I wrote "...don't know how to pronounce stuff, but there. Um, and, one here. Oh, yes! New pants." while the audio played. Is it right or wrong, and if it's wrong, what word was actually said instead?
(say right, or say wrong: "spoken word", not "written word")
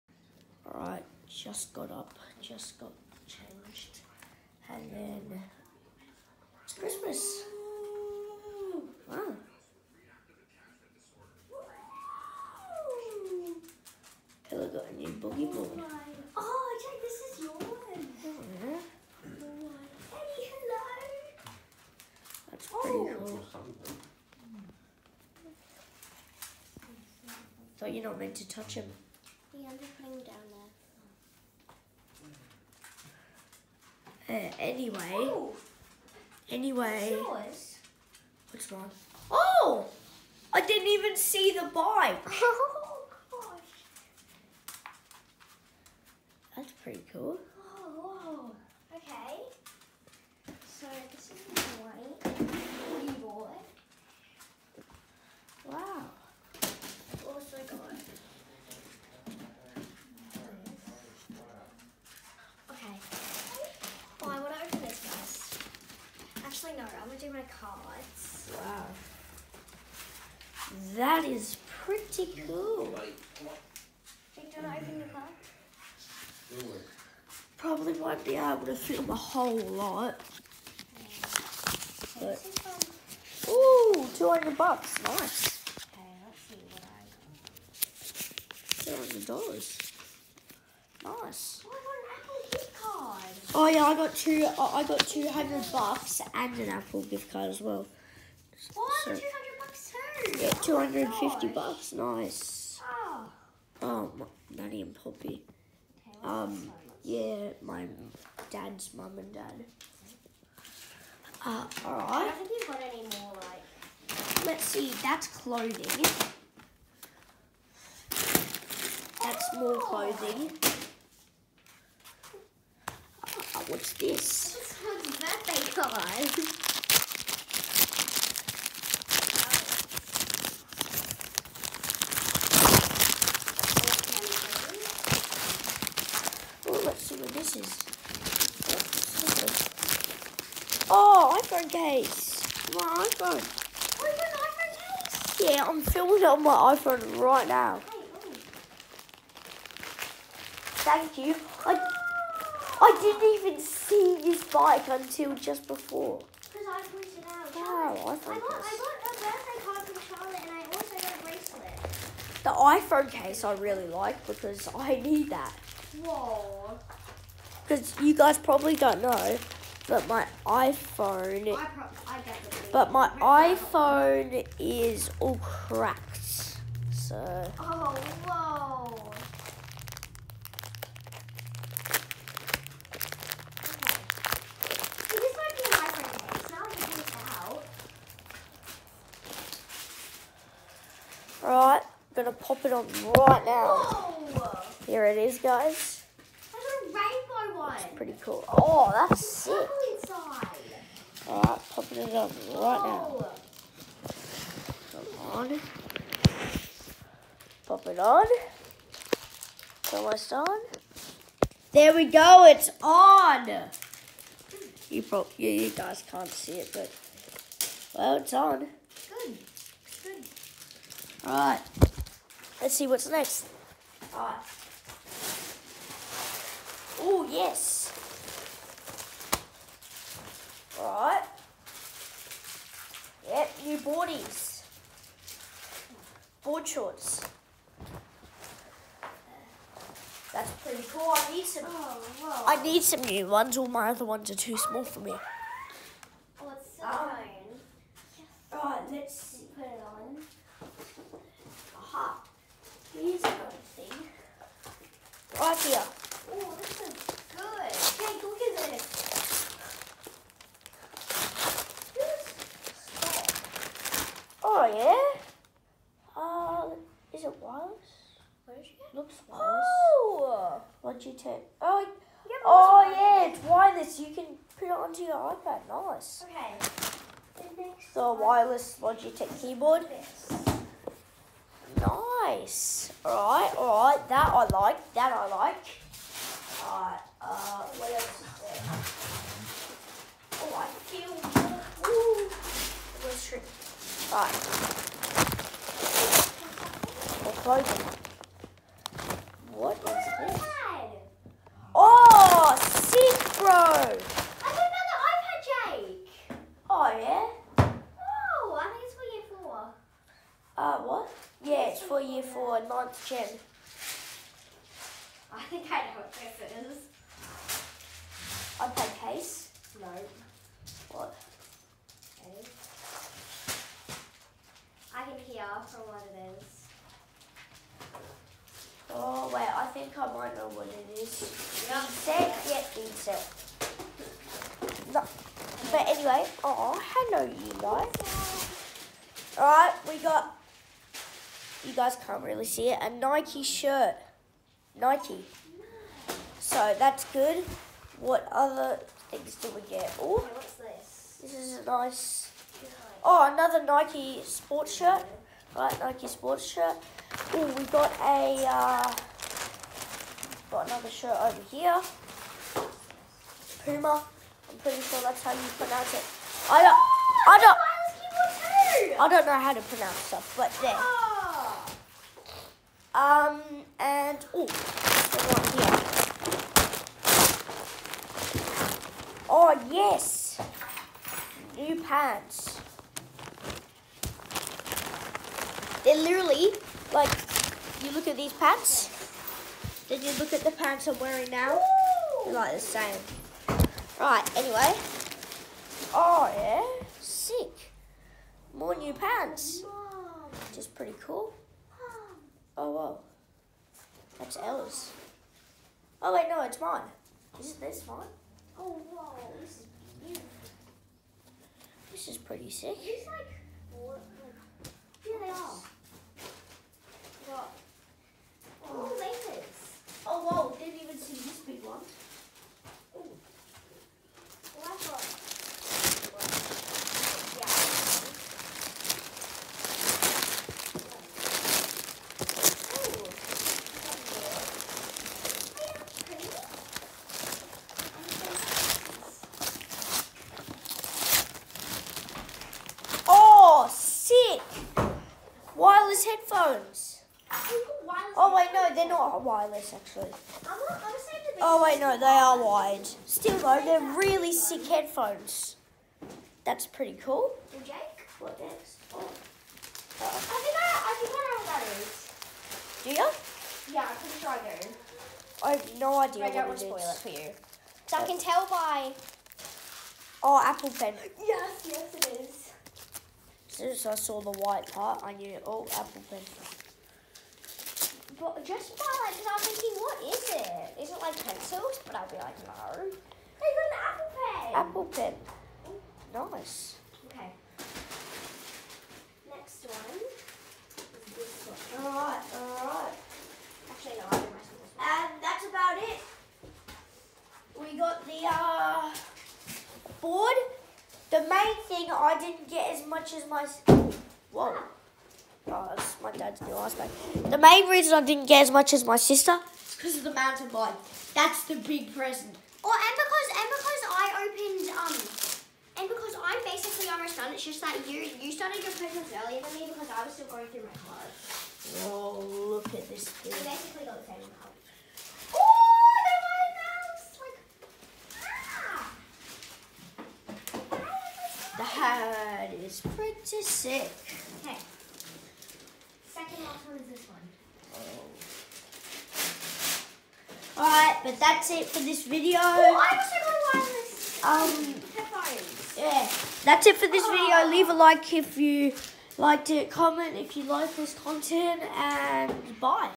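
right.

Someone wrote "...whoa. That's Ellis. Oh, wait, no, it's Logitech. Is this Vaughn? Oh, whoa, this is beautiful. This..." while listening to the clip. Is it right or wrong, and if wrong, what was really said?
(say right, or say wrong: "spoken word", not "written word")
wrong: "Vaughn", not "Logitech".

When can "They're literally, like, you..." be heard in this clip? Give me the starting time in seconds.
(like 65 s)
385 s.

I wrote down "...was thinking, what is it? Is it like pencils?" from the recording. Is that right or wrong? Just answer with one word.
right.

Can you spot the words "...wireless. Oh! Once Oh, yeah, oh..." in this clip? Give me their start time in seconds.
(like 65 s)
269 s.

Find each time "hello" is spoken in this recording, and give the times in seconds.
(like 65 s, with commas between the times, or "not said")
14 s, 19 s, 336 s.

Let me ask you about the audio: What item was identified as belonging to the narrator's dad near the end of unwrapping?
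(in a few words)
Ice bag.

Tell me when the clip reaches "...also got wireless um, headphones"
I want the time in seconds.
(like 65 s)
542 s.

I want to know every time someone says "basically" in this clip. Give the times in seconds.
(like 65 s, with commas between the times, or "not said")
516 s, 523 s.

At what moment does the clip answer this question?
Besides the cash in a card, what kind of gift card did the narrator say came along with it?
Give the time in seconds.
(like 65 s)
96 s.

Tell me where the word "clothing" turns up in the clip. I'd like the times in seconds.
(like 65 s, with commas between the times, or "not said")
115 s, 119 s.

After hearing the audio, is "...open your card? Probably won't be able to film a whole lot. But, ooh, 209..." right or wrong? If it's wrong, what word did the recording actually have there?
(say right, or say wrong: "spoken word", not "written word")
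wrong: "200", not "209".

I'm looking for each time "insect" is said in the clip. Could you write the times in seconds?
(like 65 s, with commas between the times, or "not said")
332 s.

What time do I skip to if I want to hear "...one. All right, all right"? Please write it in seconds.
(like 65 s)
491 s.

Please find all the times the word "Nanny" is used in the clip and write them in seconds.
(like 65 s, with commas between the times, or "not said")
104 s.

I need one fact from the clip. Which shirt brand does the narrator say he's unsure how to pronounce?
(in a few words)
Puma.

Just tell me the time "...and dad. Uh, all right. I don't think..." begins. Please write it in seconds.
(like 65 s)
109 s.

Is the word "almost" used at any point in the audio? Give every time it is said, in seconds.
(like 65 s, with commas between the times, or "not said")
209 s, 516 s.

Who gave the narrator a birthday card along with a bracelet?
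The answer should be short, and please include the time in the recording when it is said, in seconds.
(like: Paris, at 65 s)
Charlotte, at 160 s.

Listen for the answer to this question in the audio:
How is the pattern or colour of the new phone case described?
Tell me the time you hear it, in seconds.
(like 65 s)
196 s.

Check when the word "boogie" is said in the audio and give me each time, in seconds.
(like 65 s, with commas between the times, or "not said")
15 s.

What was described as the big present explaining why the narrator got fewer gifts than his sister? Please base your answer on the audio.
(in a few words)
Mountain bike.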